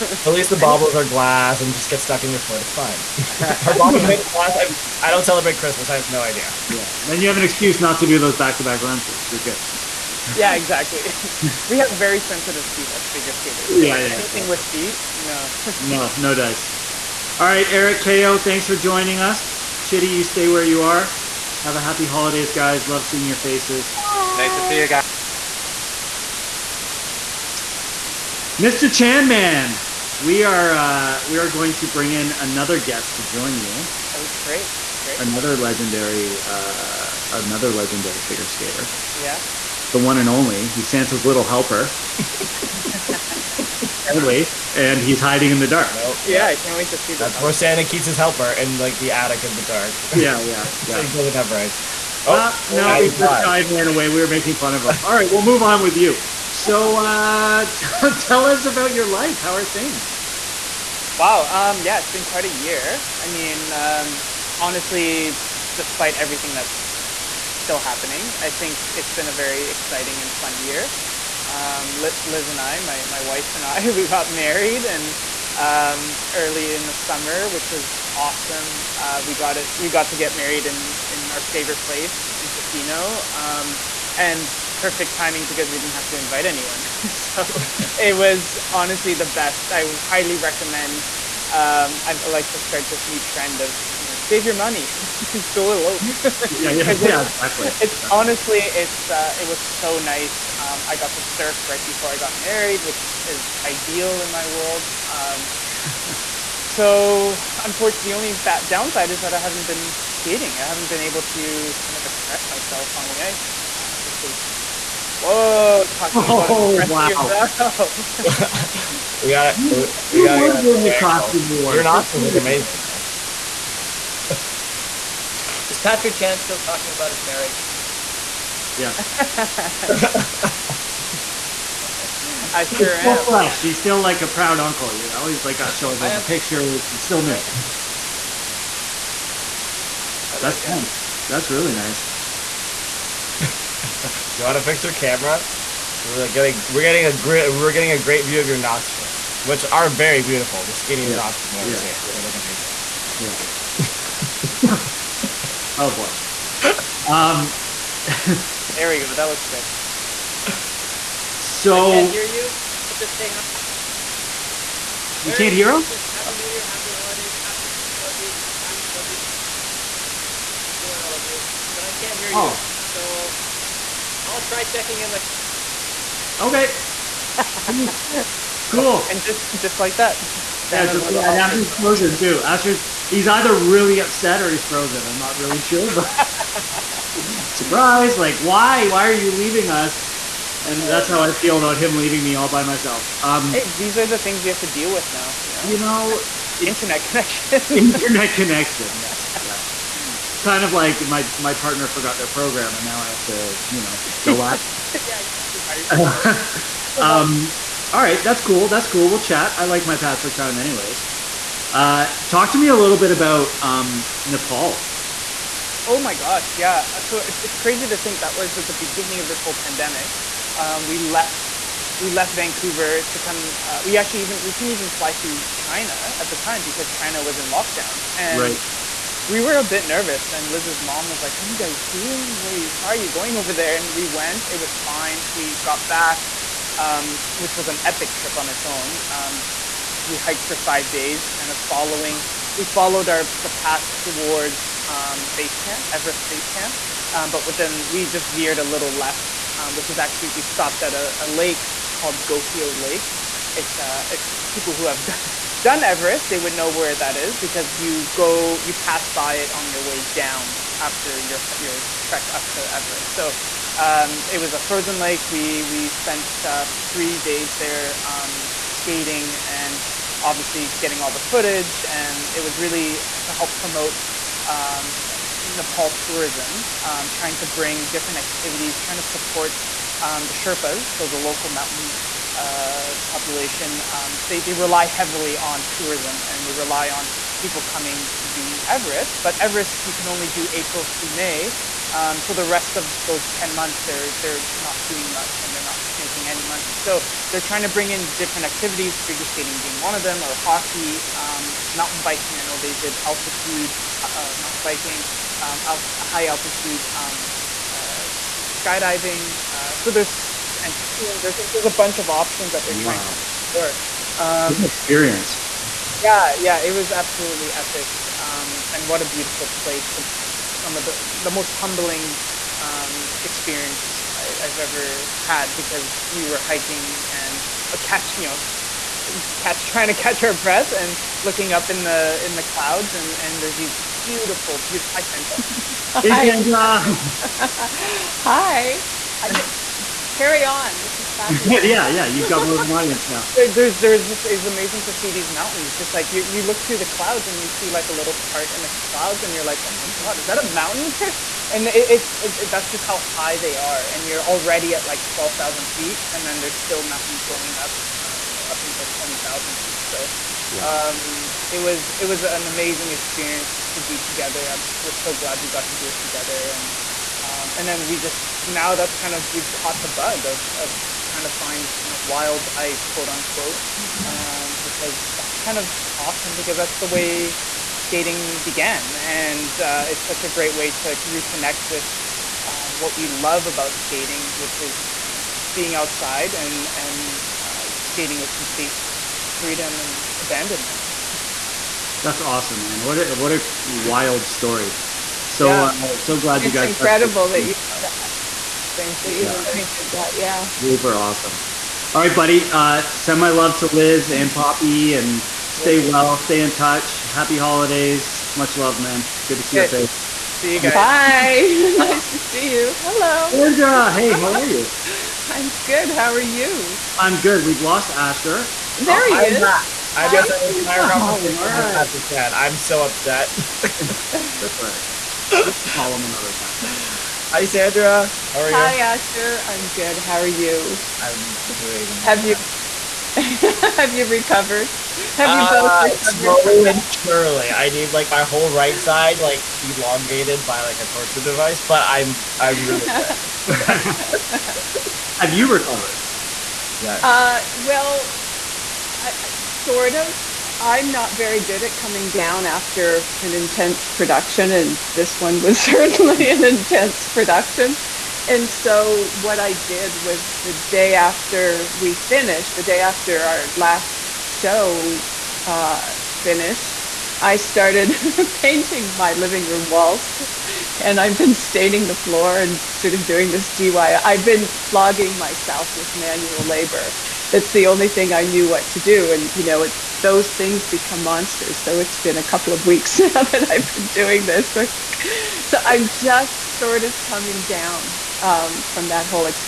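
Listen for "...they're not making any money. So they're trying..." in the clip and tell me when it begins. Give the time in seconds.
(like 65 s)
295 s.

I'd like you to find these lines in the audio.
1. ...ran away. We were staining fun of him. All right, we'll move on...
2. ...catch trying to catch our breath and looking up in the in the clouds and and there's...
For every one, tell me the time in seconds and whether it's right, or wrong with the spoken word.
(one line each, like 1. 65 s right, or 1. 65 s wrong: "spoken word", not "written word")
1. 53 s wrong: "making", not "staining"
2. 329 s right.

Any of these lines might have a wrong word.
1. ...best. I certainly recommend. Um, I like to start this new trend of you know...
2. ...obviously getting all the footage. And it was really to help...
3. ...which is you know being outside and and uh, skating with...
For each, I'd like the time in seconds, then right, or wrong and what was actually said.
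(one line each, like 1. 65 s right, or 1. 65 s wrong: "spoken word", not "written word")
1. 89 s wrong: "highly", not "certainly"
2. 270 s right
3. 384 s right.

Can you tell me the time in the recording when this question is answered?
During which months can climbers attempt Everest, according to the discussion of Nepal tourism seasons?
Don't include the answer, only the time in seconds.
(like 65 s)
290 s.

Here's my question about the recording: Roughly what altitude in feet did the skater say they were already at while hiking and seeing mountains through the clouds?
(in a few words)
12,000 feet.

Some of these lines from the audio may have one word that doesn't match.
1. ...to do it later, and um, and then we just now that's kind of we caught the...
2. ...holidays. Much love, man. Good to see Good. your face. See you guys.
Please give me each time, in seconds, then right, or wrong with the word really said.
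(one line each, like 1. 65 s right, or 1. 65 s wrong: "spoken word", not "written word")
1. 365 s wrong: "together", not "later"
2. 407 s right.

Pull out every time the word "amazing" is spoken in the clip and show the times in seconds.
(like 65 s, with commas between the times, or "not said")
122 s, 152 s, 344 s, 362 s.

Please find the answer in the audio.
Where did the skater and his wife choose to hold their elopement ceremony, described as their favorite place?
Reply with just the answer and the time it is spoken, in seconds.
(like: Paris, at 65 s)
Tofino, at 82 s.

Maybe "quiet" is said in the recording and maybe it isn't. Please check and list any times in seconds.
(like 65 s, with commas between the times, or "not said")
not said.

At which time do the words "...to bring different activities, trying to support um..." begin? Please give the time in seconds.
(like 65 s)
277 s.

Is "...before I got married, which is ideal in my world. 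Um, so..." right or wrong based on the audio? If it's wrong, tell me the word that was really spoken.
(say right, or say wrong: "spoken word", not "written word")
right.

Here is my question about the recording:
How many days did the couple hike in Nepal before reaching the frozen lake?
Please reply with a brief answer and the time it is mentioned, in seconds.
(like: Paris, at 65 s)
5, at 240 s.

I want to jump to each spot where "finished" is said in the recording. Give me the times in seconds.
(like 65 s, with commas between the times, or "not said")
461 s, 466 s.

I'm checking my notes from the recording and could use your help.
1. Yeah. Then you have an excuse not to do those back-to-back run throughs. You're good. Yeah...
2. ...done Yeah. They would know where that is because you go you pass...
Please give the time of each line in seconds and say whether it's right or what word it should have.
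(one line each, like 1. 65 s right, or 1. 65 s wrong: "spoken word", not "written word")
1. 6 s right
2. 255 s wrong: "Everest", not "Yeah".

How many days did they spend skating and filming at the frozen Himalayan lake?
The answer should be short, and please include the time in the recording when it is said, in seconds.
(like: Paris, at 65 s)
3, at 266 s.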